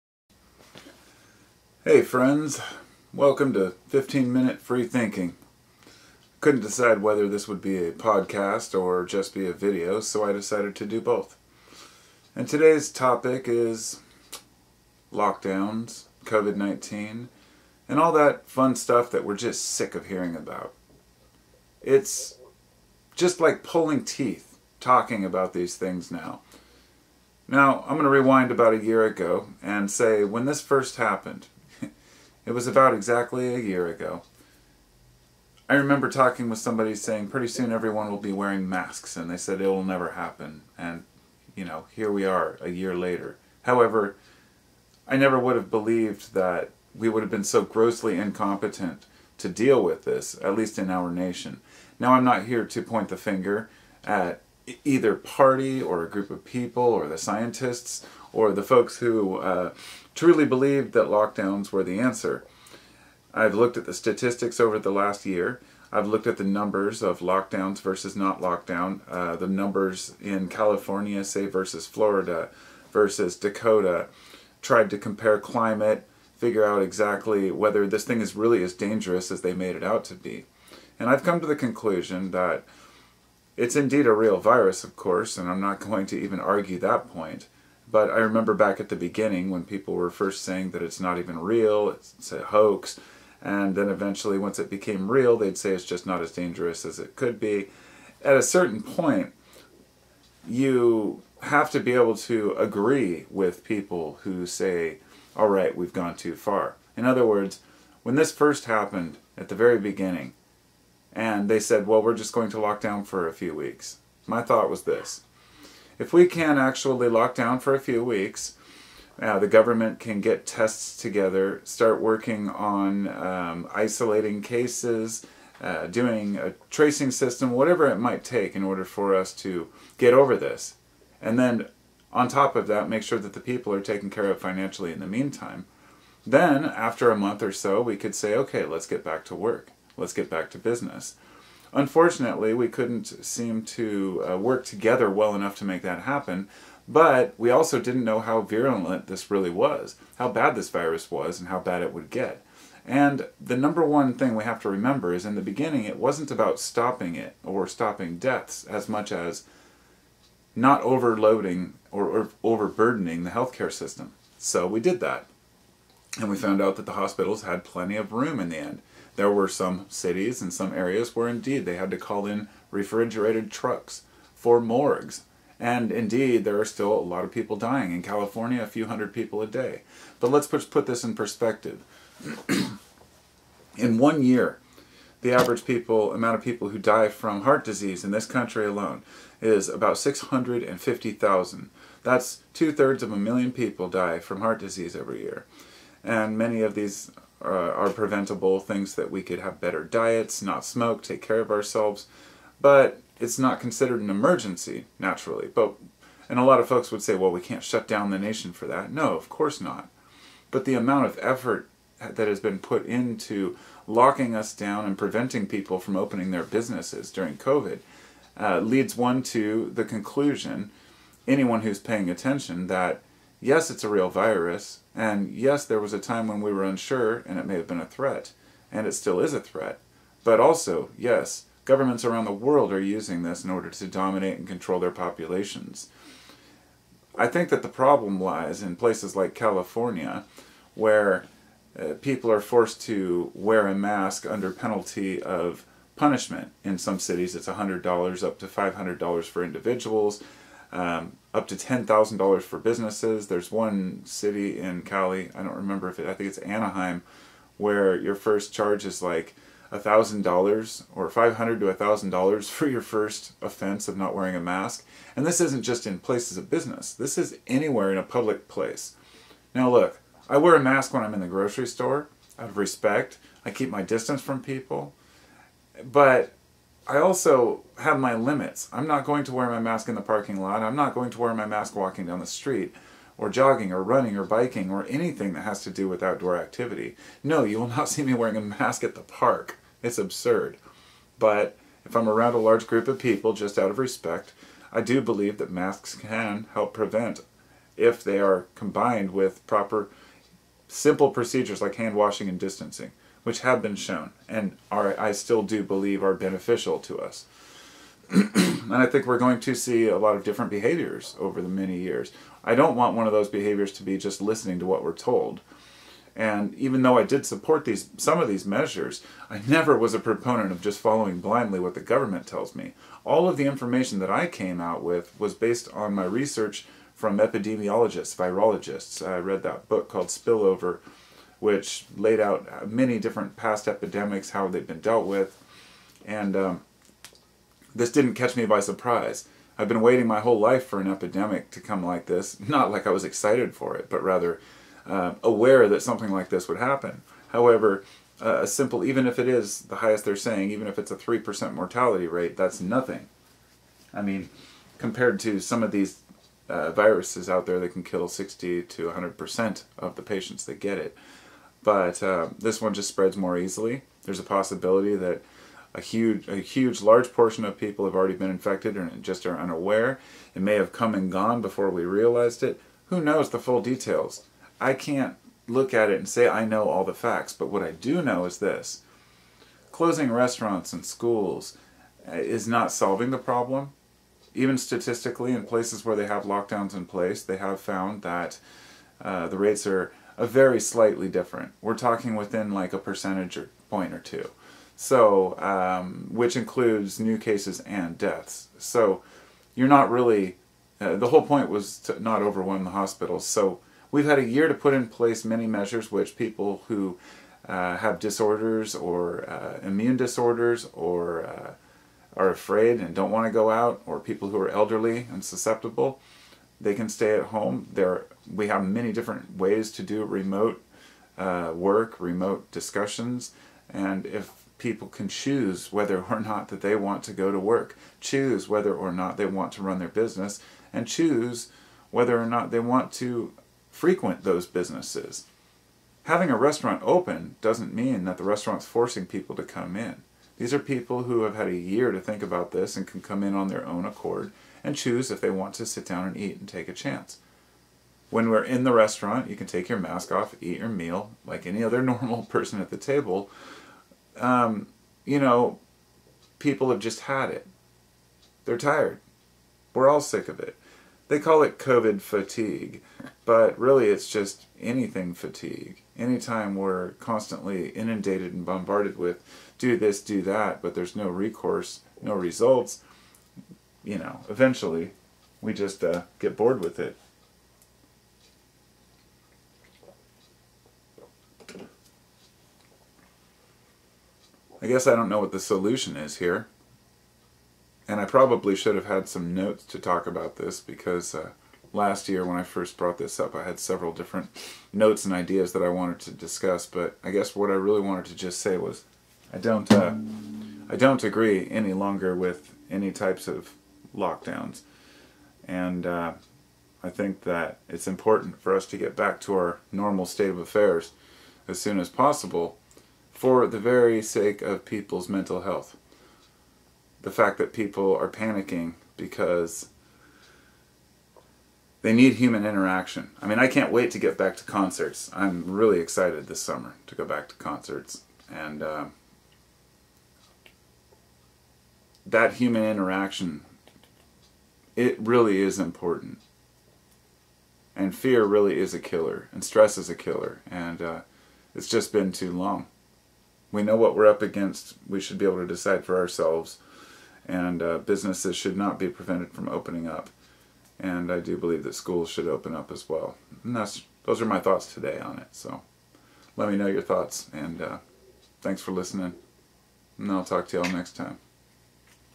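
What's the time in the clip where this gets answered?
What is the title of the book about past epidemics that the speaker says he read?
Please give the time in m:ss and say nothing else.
5:30.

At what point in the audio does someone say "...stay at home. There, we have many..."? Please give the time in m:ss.
6:56.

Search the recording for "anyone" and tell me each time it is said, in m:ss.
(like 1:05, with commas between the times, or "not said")
3:41.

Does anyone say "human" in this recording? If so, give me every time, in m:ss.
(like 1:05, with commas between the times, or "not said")
8:42, 8:52.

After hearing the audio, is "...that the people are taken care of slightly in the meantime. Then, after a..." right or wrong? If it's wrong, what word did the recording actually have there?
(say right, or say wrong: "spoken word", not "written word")
wrong: "financially", not "slightly".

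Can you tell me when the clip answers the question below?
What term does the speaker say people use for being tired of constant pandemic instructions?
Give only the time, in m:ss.
7:41.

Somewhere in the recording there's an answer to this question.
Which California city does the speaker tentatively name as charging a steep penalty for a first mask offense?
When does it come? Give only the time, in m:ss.
4:16.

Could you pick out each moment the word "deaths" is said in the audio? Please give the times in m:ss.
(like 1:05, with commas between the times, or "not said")
2:38, 6:37.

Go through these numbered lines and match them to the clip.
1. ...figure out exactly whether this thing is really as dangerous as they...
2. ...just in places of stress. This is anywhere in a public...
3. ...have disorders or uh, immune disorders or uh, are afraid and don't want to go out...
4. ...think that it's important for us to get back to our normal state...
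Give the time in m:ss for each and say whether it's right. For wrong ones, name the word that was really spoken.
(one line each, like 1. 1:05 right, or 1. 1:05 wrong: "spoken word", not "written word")
1. 1:16 right
2. 4:25 wrong: "business", not "stress"
3. 6:47 right
4. 8:26 right.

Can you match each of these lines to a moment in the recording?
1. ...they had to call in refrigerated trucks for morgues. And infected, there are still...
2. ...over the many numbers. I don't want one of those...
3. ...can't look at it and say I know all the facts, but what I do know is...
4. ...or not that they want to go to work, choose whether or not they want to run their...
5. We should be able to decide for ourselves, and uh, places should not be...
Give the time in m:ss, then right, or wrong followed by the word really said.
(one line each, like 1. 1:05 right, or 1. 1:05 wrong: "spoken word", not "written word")
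1. 2:51 wrong: "indeed", not "infected"
2. 5:11 wrong: "years", not "numbers"
3. 6:14 right
4. 7:06 right
5. 9:04 wrong: "businesses", not "places".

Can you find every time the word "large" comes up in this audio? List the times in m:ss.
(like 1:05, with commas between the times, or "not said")
4:52, 6:06.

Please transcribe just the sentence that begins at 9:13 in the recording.
And that's, those are my thoughts today on it.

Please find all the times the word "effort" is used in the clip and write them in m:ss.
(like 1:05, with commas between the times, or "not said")
3:31.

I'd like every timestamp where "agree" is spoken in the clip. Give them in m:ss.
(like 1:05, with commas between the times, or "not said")
1:42, 8:21.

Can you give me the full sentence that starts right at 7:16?
Having a restaurant open doesn't mean that the restaurant's forcing people to come in.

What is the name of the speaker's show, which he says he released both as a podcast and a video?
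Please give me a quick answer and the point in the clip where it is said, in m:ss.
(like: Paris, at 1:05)
15 Minute Free Thinking, at 0:03.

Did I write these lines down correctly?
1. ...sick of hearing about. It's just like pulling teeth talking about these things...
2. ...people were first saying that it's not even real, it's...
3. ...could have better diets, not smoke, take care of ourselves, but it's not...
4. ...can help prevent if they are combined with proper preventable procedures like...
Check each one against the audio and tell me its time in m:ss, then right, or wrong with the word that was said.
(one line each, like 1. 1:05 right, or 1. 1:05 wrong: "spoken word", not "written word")
1. 0:19 right
2. 1:29 right
3. 3:19 right
4. 4:55 wrong: "simple", not "preventable".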